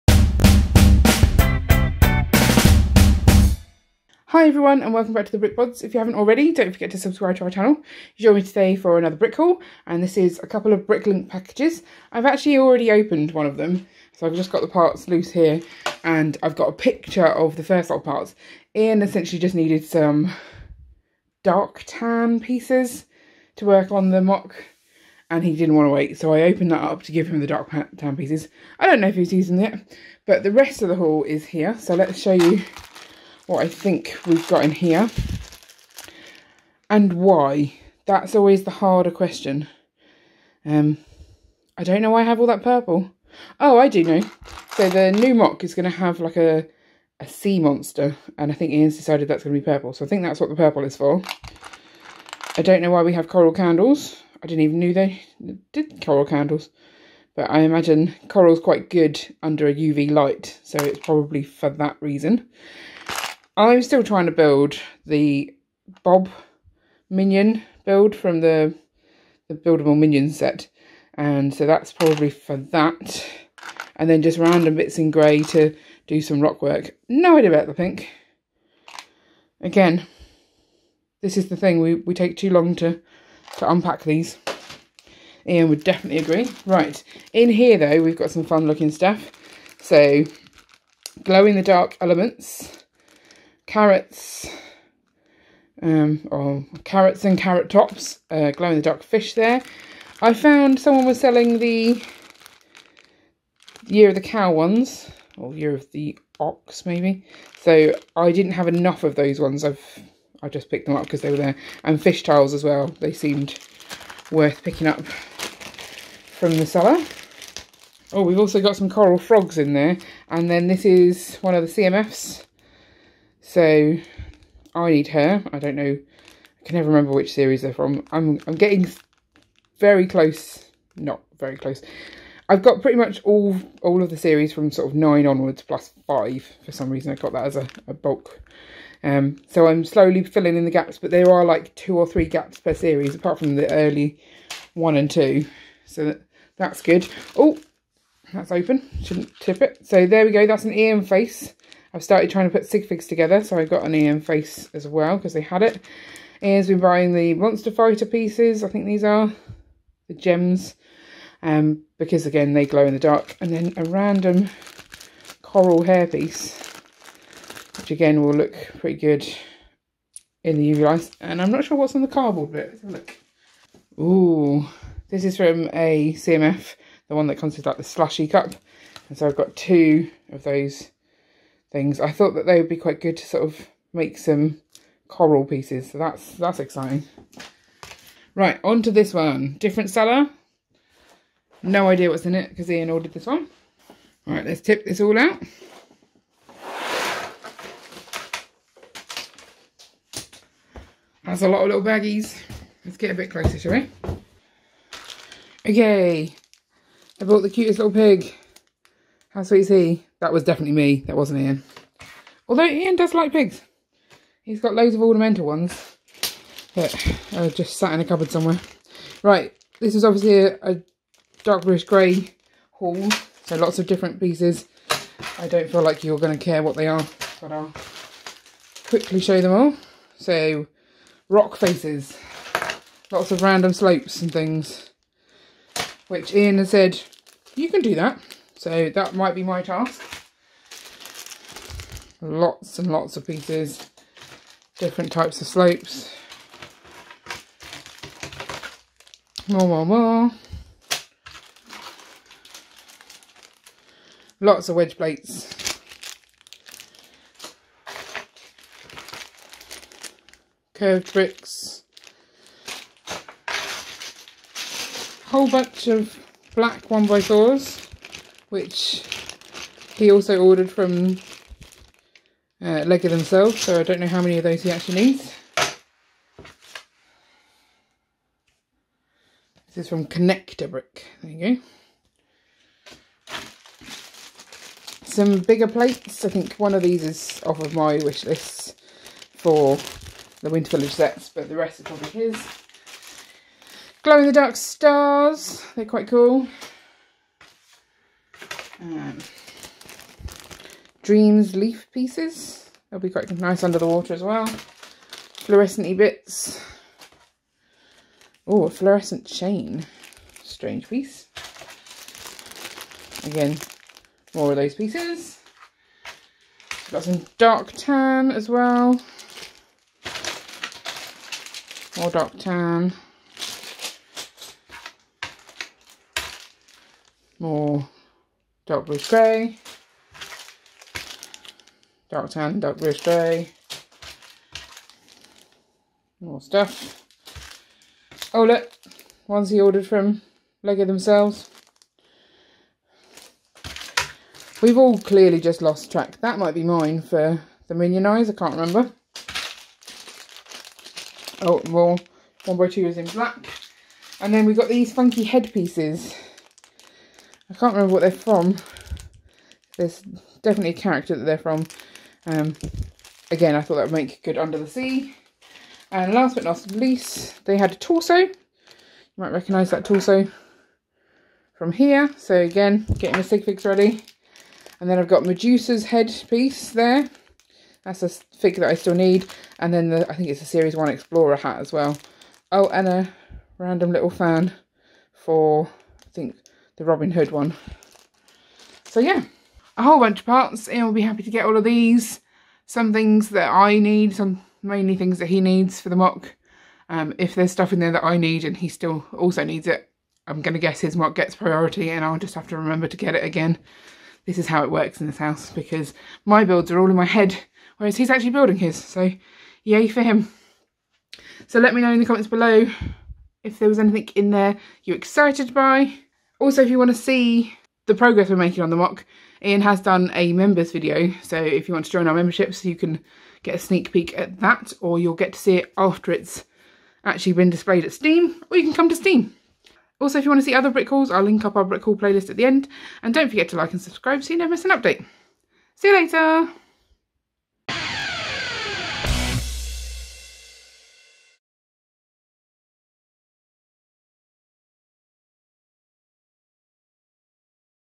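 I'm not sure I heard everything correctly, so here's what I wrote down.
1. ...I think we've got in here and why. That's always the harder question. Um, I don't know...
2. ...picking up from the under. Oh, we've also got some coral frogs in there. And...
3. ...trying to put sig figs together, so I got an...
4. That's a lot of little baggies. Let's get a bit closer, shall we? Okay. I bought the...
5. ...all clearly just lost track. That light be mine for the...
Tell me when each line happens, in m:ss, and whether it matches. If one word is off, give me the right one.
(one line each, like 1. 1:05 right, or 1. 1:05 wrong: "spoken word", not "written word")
1. 0:33 right
2. 1:54 wrong: "seller", not "under"
3. 2:32 right
4. 3:21 right
5. 5:44 wrong: "might", not "light".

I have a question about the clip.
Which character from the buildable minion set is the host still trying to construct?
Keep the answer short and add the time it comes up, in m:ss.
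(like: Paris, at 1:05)
Bob, at 1:06.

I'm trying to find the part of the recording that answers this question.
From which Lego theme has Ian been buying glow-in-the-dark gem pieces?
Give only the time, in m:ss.
2:37.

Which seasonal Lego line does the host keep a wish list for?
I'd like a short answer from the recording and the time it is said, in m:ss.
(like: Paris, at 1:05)
Winter Village, at 4:50.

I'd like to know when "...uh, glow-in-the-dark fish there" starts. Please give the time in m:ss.
1:38.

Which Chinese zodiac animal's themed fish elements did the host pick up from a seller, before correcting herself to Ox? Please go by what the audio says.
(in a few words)
Year of the Cow.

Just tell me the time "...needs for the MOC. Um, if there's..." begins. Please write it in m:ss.
6:35.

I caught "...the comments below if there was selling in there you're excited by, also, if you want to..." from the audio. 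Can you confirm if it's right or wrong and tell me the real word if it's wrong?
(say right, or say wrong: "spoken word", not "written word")
wrong: "anything", not "selling".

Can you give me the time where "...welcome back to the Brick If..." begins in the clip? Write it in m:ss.
0:04.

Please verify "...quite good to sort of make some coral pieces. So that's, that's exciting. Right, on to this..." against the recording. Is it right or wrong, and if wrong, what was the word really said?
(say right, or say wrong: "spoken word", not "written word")
right.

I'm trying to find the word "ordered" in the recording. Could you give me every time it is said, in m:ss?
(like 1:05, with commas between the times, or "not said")
3:12, 4:30, 5:39.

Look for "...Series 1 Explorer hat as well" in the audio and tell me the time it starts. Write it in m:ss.
6:20.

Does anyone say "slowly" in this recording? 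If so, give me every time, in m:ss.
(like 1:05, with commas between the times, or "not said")
2:19.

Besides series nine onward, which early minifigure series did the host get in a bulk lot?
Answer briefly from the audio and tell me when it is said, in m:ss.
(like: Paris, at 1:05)
5, at 2:16.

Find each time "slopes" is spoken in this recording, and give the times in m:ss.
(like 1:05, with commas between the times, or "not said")
3:53, 4:05.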